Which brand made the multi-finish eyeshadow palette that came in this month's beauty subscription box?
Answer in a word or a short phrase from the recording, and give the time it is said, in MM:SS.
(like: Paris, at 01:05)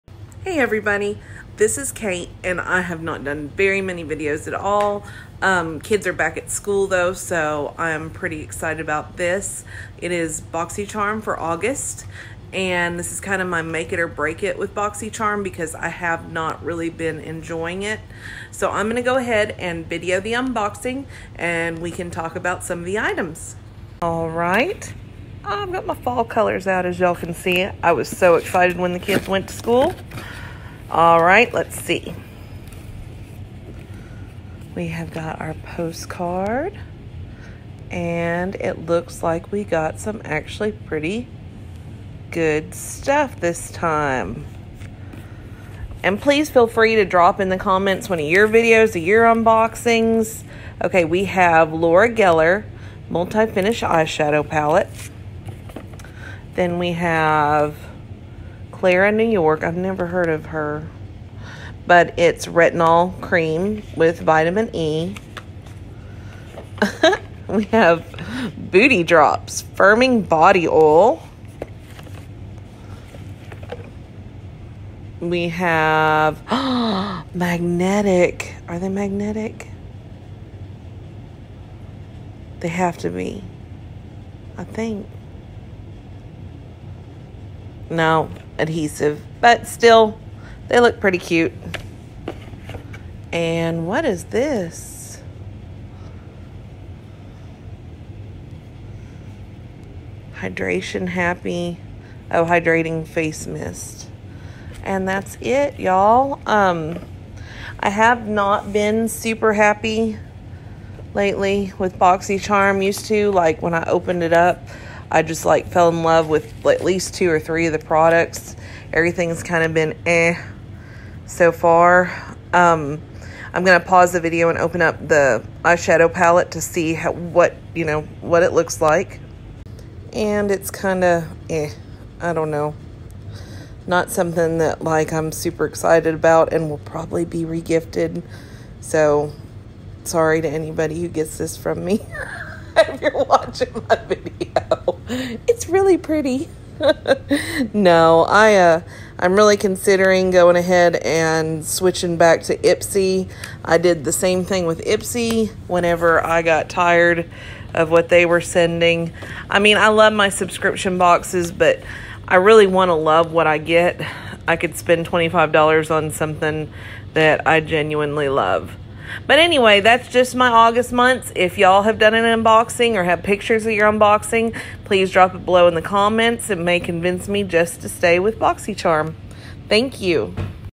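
Laura Geller, at 00:51.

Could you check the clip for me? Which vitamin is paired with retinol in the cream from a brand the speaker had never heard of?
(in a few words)
Vitamin E.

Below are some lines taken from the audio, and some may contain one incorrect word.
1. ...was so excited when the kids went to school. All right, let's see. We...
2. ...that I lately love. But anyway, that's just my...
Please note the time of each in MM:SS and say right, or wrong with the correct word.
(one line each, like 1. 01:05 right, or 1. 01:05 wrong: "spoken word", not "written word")
1. 00:27 right
2. 02:47 wrong: "genuinely", not "lately".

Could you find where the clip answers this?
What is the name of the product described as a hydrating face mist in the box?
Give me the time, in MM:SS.
01:40.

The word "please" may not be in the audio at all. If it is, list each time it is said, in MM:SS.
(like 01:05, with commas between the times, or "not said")
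00:46, 02:54.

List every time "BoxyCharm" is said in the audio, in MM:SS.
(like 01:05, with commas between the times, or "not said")
00:10, 00:14, 01:51, 02:58.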